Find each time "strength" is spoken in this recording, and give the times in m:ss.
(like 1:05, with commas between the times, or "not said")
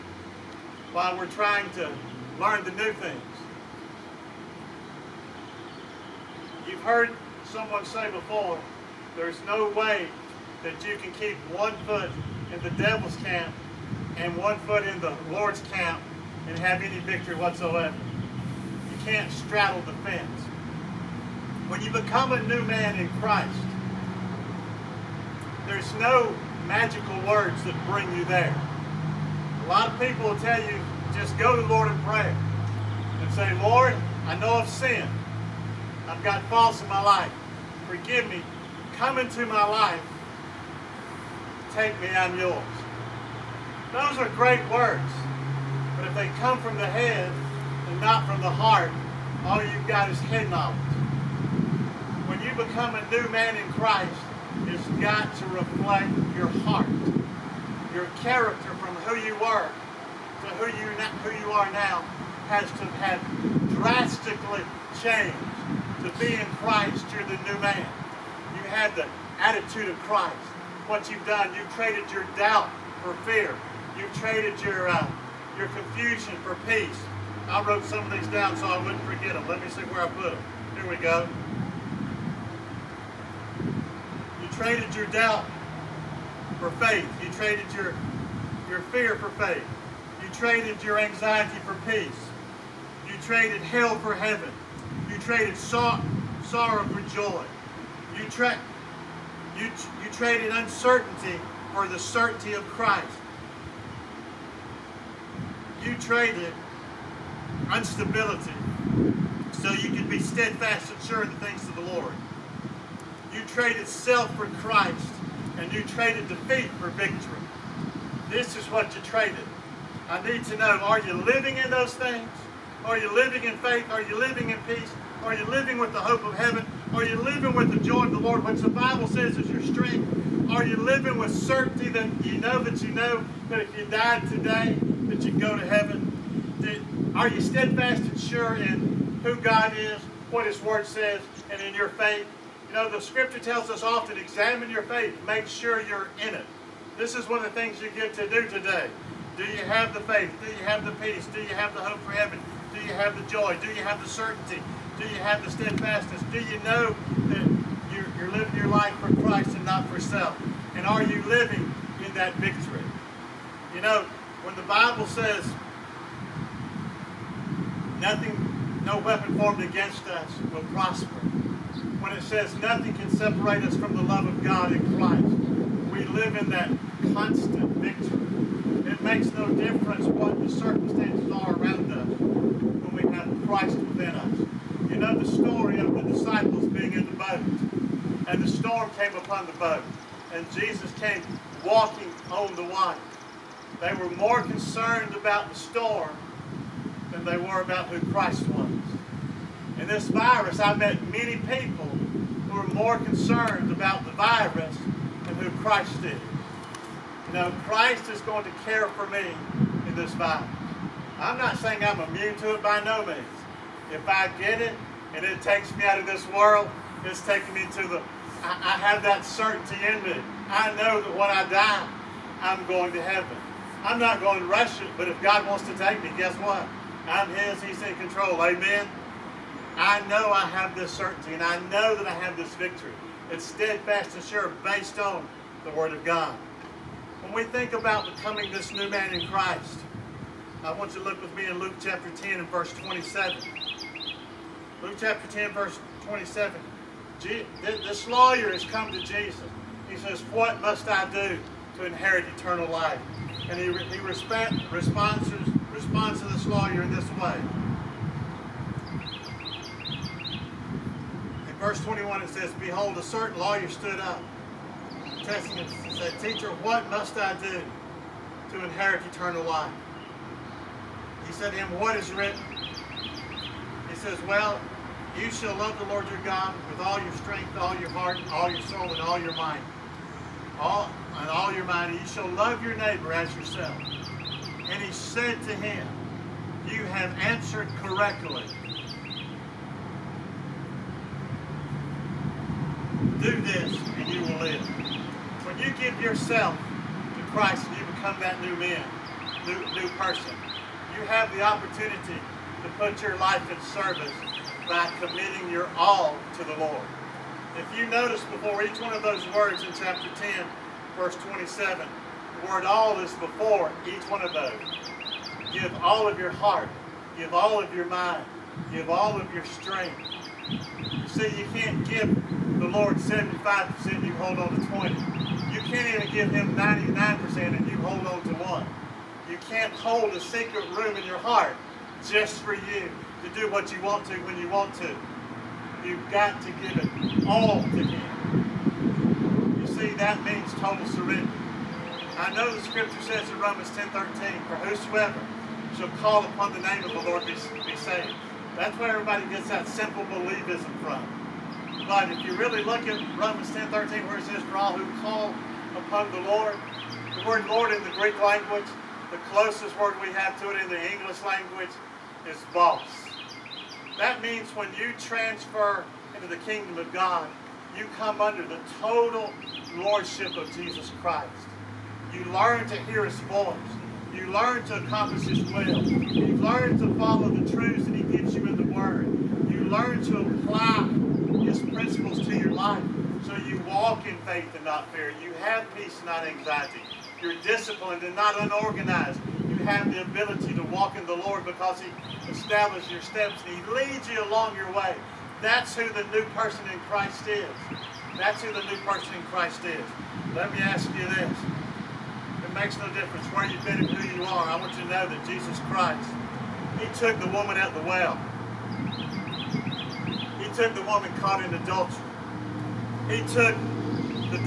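2:09, 4:37, 5:19.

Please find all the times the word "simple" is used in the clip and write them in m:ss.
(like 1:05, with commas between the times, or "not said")
5:49.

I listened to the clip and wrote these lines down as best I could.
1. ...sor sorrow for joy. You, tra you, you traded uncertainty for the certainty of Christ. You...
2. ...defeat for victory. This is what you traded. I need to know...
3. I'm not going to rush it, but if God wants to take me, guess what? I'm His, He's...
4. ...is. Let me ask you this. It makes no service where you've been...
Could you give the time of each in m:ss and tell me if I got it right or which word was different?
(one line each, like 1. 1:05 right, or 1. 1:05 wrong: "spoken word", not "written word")
1. 1:35 right
2. 1:56 right
3. 3:43 right
4. 6:39 wrong: "difference", not "service".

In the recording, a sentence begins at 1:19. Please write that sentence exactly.
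Let me see where I put them.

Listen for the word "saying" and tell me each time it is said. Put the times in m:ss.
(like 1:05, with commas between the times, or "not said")
3:31.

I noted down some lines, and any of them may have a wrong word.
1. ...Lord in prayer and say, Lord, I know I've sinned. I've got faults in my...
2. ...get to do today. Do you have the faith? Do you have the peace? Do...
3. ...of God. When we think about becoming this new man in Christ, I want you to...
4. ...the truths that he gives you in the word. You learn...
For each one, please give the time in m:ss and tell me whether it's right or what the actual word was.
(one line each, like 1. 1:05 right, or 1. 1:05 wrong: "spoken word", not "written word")
1. 0:31 right
2. 2:27 right
3. 3:55 right
4. 6:17 right.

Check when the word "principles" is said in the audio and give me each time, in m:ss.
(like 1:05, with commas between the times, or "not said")
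6:21.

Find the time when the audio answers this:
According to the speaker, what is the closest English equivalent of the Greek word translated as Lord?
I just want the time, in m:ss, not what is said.
6:02.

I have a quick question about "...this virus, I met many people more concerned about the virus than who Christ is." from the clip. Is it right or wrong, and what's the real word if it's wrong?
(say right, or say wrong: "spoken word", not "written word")
right.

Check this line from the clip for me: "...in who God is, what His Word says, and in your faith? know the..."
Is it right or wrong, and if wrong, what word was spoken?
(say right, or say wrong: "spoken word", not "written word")
right.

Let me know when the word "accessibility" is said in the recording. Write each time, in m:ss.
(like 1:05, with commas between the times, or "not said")
not said.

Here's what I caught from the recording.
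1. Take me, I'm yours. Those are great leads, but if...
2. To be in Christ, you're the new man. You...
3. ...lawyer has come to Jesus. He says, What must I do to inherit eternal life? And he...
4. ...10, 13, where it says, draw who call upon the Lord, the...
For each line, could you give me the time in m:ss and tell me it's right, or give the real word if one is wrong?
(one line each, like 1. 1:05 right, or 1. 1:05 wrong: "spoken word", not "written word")
1. 0:41 wrong: "words", not "leads"
2. 1:06 right
3. 4:08 right
4. 5:53 right.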